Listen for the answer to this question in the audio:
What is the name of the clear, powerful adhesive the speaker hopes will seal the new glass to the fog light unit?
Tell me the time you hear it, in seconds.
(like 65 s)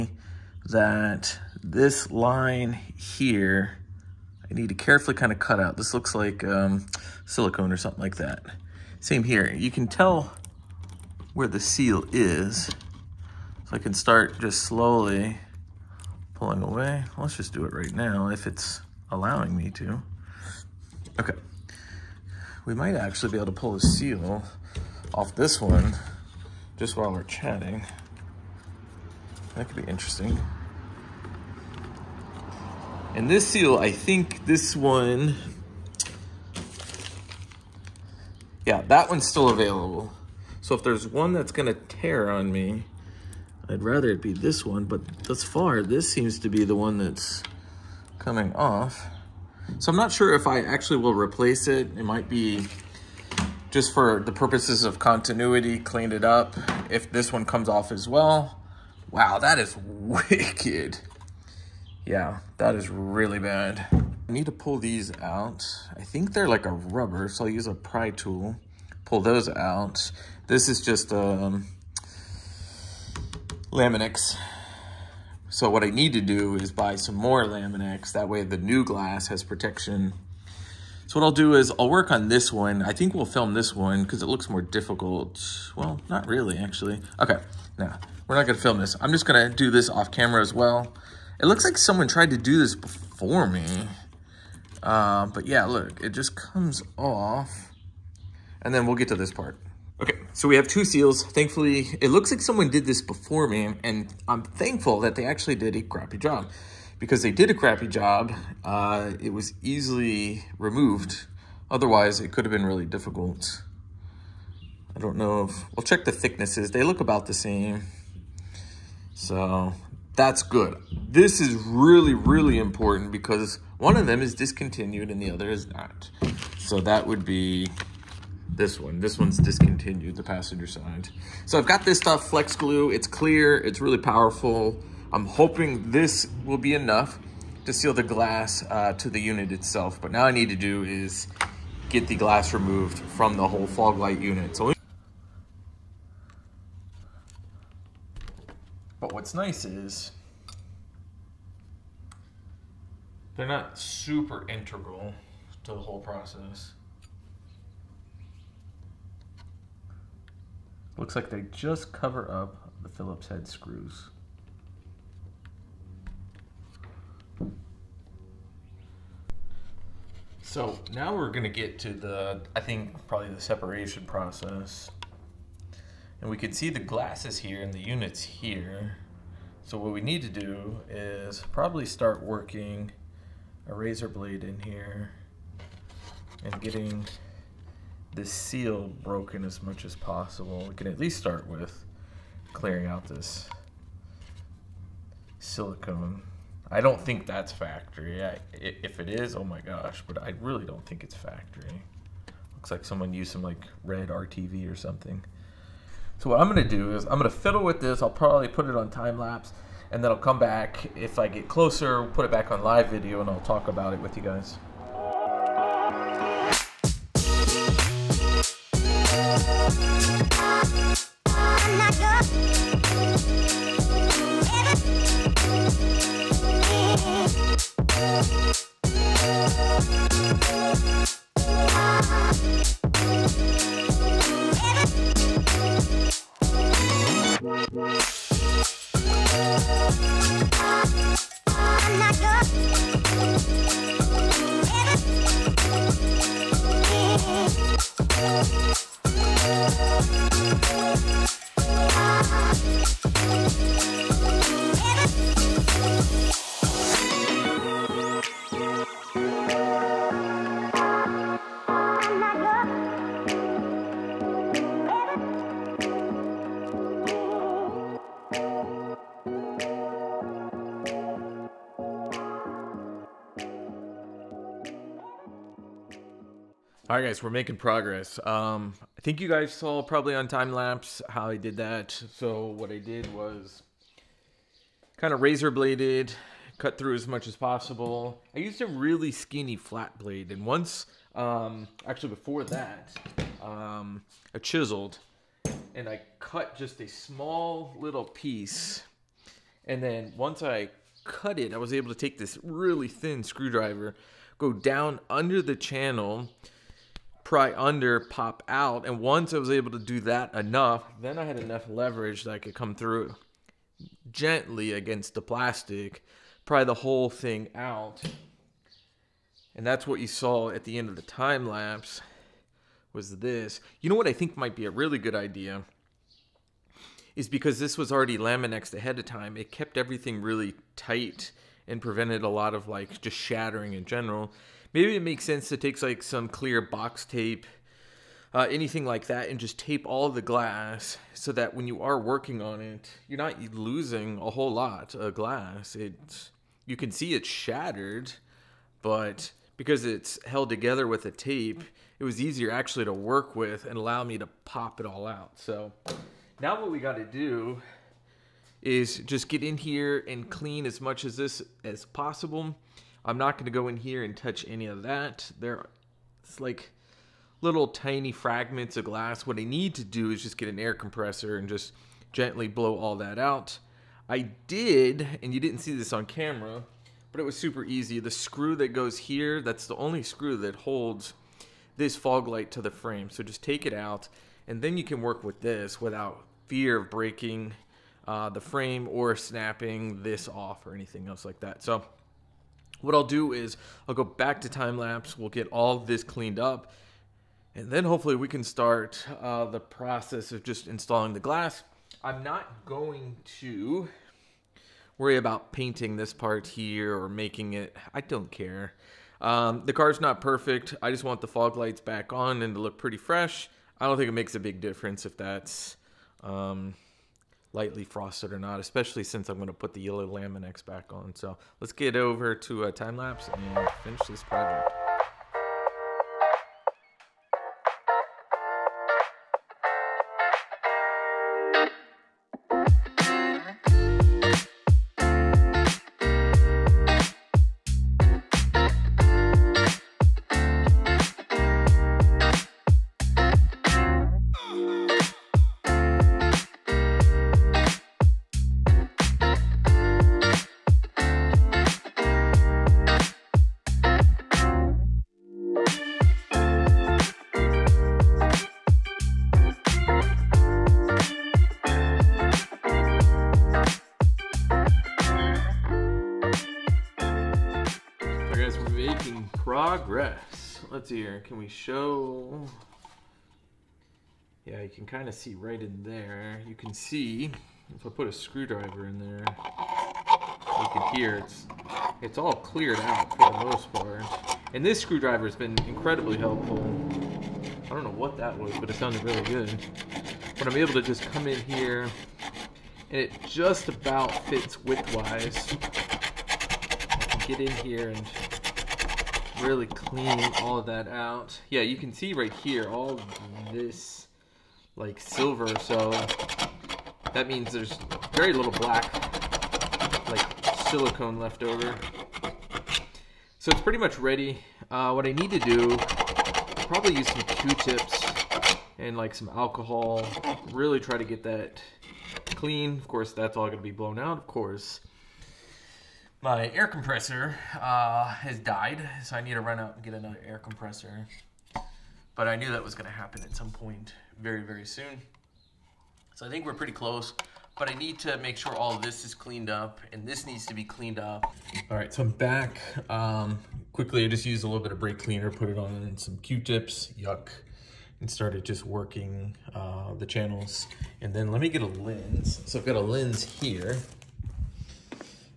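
132 s.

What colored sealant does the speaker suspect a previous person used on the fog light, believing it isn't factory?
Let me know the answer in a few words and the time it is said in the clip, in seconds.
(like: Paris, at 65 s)
red RTV, at 203 s.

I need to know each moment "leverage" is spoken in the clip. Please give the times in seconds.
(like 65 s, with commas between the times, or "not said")
311 s.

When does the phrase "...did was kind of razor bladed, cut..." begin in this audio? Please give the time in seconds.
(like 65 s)
282 s.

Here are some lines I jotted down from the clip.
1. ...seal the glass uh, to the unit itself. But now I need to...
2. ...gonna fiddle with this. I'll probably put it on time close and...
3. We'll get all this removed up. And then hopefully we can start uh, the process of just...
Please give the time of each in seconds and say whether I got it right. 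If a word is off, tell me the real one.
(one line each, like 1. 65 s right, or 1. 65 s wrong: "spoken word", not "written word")
1. 137 s right
2. 207 s wrong: "lapse", not "close"
3. 395 s wrong: "cleaned", not "removed".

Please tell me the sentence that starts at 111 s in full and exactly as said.
Otherwise, it could have been really difficult.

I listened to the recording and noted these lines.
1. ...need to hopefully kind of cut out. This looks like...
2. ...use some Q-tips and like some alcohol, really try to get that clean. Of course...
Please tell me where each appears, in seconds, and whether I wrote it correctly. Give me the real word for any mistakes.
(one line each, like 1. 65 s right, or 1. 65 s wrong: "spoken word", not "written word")
1. 4 s wrong: "carefully", not "hopefully"
2. 516 s right.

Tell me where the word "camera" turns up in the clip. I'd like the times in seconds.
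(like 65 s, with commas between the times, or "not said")
90 s, 376 s.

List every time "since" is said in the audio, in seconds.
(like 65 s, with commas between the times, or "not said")
419 s.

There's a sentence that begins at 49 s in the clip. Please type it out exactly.
So I'm not sure if I actually will replace it.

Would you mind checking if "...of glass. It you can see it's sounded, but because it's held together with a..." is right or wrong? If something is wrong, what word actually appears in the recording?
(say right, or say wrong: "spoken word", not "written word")
wrong: "shattered", not "sounded".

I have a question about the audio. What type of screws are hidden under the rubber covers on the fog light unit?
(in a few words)
Phillips head.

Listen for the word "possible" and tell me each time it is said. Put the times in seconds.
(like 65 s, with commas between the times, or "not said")
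189 s, 287 s, 361 s.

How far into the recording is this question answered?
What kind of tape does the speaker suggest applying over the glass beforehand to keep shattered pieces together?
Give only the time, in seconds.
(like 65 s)
336 s.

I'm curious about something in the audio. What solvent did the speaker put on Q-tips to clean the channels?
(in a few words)
brake cleaner.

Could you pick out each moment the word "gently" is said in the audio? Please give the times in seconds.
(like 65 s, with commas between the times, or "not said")
314 s, 372 s.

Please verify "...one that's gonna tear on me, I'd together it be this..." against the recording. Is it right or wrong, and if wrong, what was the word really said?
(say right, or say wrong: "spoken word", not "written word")
wrong: "rather", not "together".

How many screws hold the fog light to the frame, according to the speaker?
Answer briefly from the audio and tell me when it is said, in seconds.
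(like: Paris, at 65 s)
1, at 379 s.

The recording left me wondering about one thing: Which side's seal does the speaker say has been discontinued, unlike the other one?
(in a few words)
passenger side.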